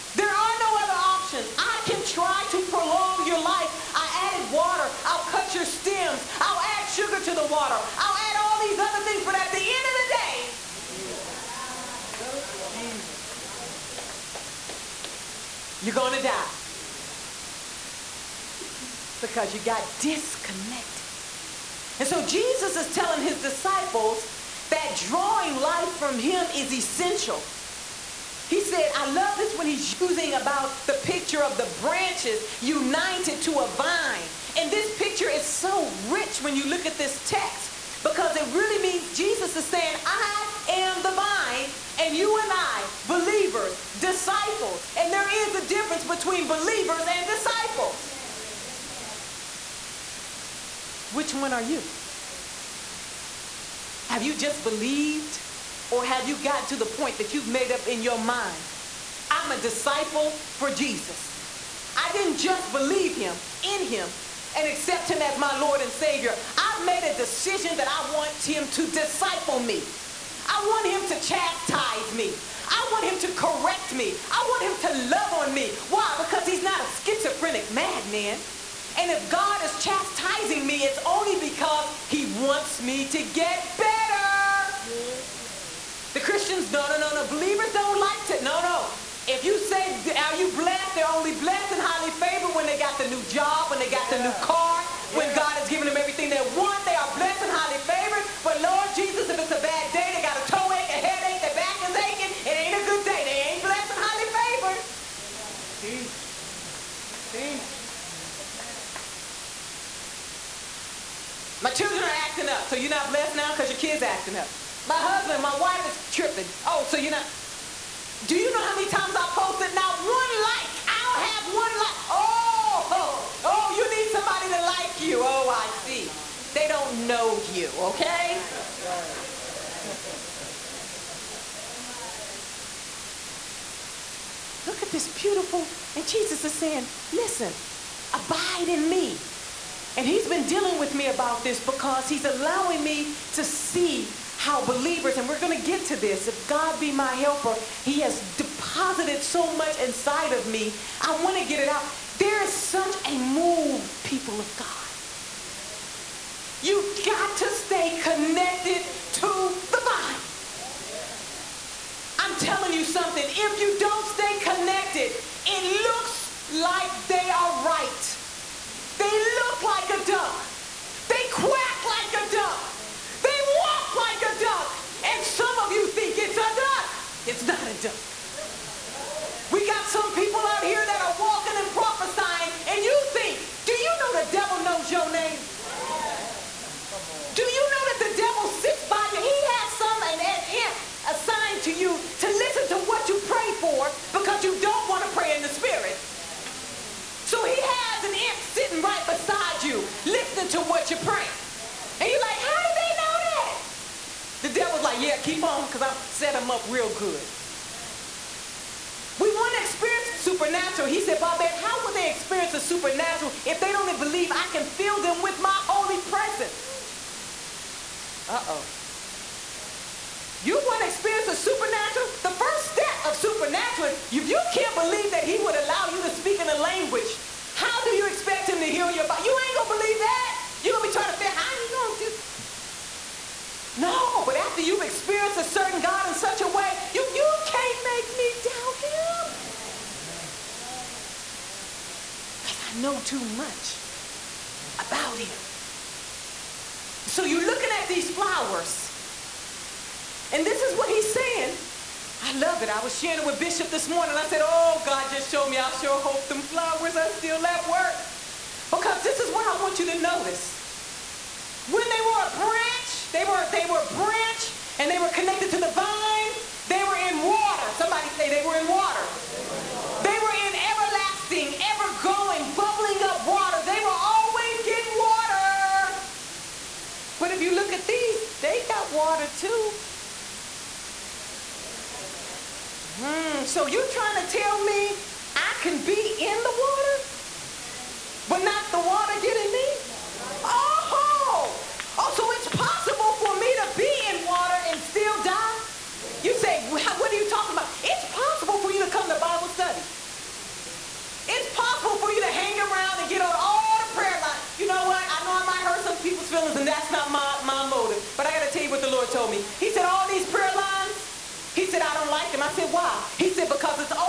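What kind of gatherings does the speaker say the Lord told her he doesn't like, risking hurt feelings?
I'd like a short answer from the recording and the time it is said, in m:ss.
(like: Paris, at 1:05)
prayer lines, at 5:10.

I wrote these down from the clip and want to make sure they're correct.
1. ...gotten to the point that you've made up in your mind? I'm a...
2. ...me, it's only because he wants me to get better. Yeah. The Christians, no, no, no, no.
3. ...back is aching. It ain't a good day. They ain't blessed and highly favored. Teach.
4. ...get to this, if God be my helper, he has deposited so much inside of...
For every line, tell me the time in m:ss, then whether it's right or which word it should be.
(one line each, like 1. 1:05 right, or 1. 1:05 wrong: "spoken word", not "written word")
1. 0:56 right
2. 1:20 right
3. 1:41 right
4. 2:25 right.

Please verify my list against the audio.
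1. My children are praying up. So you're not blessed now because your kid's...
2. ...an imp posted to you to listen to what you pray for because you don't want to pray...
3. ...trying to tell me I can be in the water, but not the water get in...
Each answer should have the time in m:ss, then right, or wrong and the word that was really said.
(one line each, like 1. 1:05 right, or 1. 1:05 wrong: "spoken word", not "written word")
1. 1:51 wrong: "acting", not "praying"
2. 3:10 wrong: "assigned", not "posted"
3. 4:43 right.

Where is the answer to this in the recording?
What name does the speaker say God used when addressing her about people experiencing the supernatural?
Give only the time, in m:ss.
3:31.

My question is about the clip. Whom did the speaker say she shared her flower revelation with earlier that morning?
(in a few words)
Bishop.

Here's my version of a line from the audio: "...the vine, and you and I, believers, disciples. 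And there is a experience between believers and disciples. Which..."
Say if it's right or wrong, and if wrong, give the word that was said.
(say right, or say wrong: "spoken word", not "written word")
wrong: "difference", not "experience".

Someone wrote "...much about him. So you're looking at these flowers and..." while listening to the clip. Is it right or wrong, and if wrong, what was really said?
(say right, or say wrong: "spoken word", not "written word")
right.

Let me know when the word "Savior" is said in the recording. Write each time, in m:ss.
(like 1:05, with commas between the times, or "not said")
1:05.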